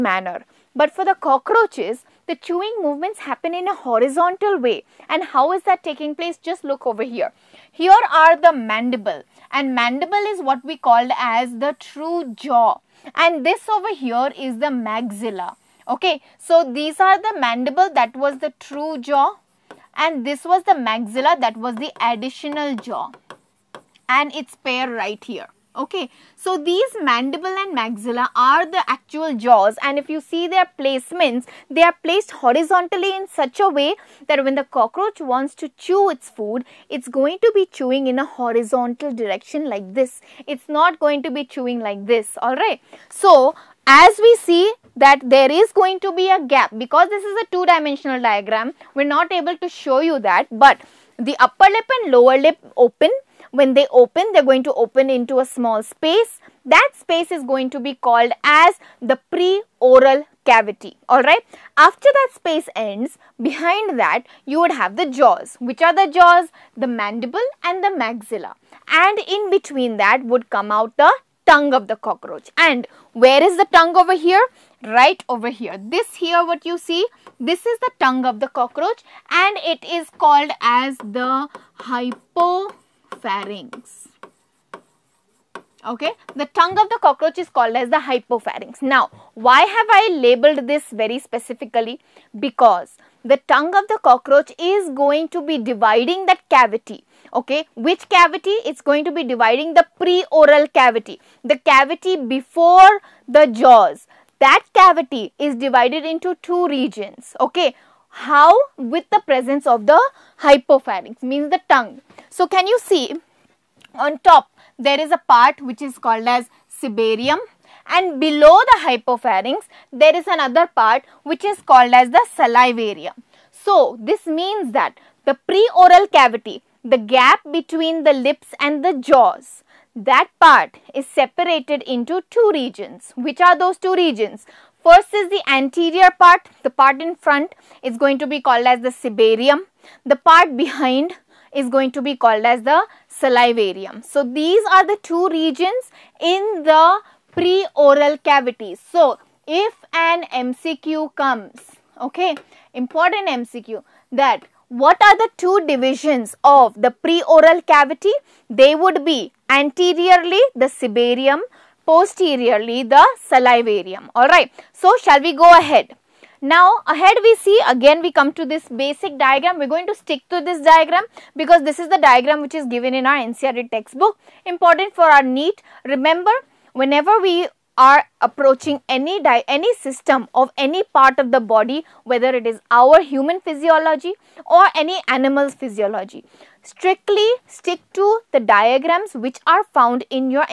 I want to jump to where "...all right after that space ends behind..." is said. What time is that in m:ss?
1:01.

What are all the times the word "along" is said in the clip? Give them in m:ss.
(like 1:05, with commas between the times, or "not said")
not said.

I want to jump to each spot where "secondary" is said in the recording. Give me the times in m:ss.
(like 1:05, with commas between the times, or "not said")
not said.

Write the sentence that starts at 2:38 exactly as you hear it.
They would be anteriorly the cibarium, posteriorly the salivarium.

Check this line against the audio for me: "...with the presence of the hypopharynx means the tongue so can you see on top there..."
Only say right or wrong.
right.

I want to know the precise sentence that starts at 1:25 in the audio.
Okay, the tongue of the cockroach is called as the hypopharynx.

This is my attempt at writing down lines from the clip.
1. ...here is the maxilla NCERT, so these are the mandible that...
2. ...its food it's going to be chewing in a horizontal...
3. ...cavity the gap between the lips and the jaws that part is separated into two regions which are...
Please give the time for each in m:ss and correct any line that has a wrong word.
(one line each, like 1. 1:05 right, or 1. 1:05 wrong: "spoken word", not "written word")
1. 0:14 wrong: "Okay", not "NCERT"
2. 0:36 right
3. 2:06 right.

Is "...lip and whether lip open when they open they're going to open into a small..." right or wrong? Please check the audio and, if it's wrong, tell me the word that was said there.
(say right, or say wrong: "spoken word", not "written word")
wrong: "lower", not "whether".